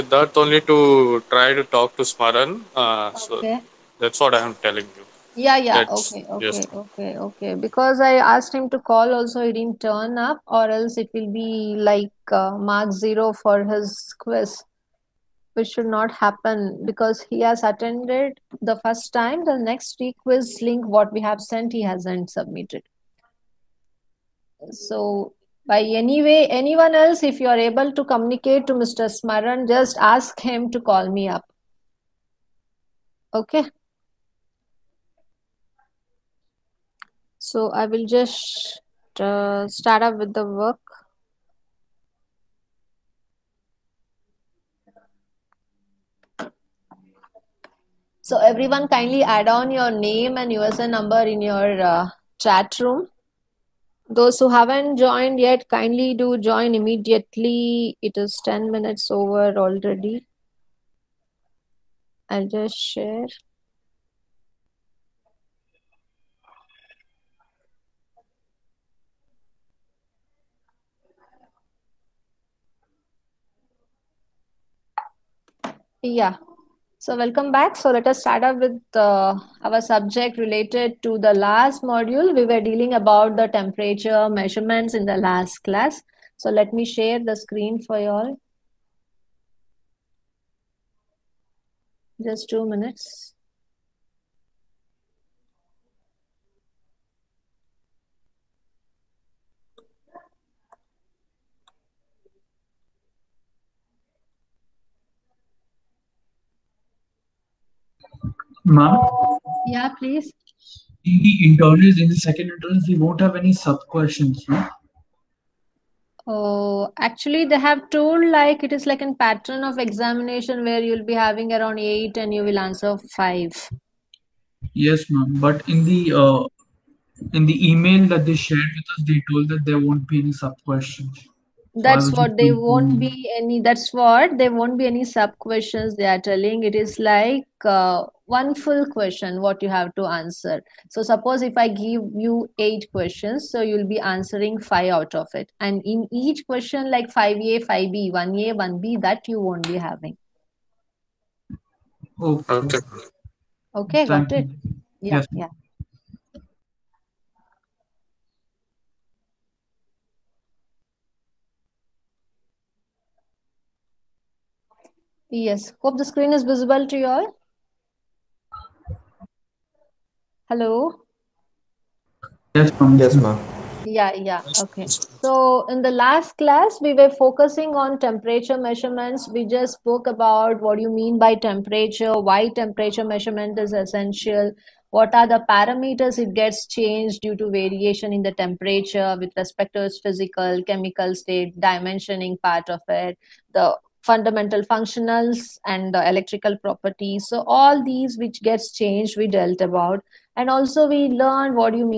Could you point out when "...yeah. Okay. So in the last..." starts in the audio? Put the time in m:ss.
2:54.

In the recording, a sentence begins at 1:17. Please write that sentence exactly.
So let us start up with uh, our subject related to the last module.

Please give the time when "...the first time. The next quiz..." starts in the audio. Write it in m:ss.
0:18.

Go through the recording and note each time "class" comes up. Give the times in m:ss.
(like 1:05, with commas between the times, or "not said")
1:25, 2:56.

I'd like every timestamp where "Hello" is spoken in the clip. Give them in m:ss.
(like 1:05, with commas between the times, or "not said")
2:50.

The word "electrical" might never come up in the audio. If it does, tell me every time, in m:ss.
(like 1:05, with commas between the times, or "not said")
3:16.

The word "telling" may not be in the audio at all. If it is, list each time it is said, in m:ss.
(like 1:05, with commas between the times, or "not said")
0:04, 2:16.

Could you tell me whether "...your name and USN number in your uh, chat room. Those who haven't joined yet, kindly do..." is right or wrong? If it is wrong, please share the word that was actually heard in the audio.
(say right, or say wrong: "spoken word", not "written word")
right.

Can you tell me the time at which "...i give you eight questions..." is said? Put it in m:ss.
2:21.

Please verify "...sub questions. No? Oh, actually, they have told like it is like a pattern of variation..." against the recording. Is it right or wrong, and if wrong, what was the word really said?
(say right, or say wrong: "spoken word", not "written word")
wrong: "examination", not "variation".